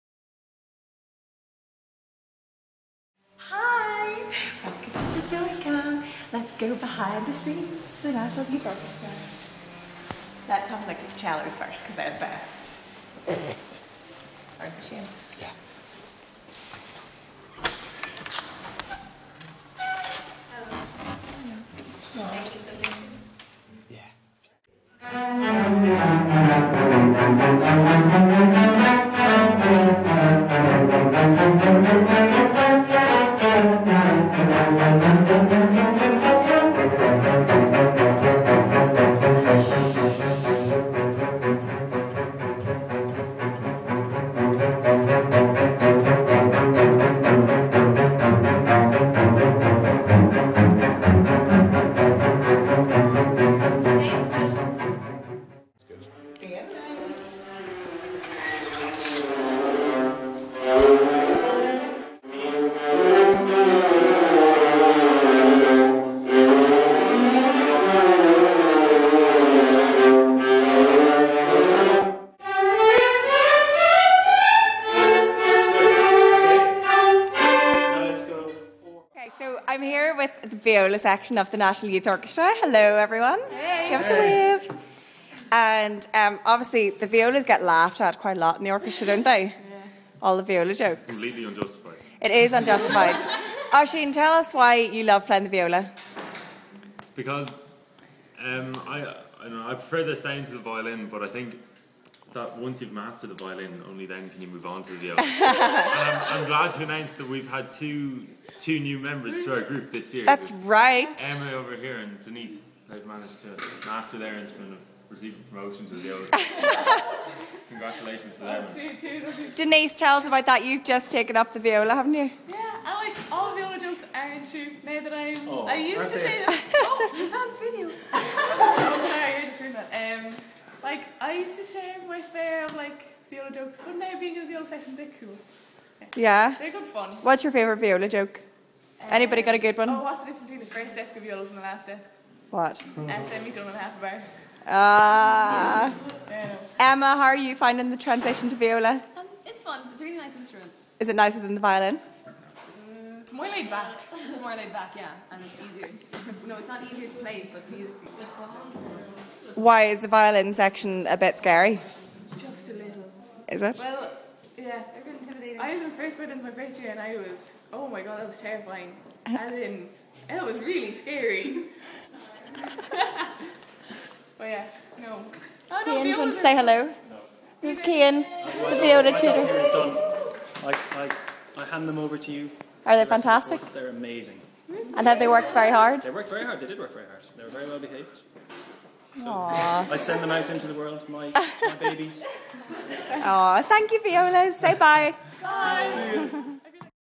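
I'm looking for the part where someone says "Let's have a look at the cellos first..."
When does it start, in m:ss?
0:10.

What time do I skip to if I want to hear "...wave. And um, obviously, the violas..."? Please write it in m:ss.
1:24.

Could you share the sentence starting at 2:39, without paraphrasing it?
Why is the violin section a bit scary?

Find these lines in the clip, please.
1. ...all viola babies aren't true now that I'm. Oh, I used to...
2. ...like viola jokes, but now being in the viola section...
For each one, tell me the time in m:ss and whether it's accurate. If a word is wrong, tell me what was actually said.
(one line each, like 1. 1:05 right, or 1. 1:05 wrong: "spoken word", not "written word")
1. 2:03 wrong: "jokes", not "babies"
2. 2:12 right.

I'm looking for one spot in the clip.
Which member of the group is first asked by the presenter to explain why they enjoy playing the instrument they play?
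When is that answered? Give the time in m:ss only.
1:33.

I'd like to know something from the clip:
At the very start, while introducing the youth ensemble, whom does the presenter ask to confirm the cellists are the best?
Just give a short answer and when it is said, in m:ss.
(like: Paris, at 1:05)
Shane, at 0:14.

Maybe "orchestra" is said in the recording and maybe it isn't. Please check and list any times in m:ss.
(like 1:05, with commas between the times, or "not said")
0:08, 1:22, 1:28.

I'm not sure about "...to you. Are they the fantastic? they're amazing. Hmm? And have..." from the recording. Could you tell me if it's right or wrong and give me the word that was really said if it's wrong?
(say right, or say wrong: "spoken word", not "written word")
right.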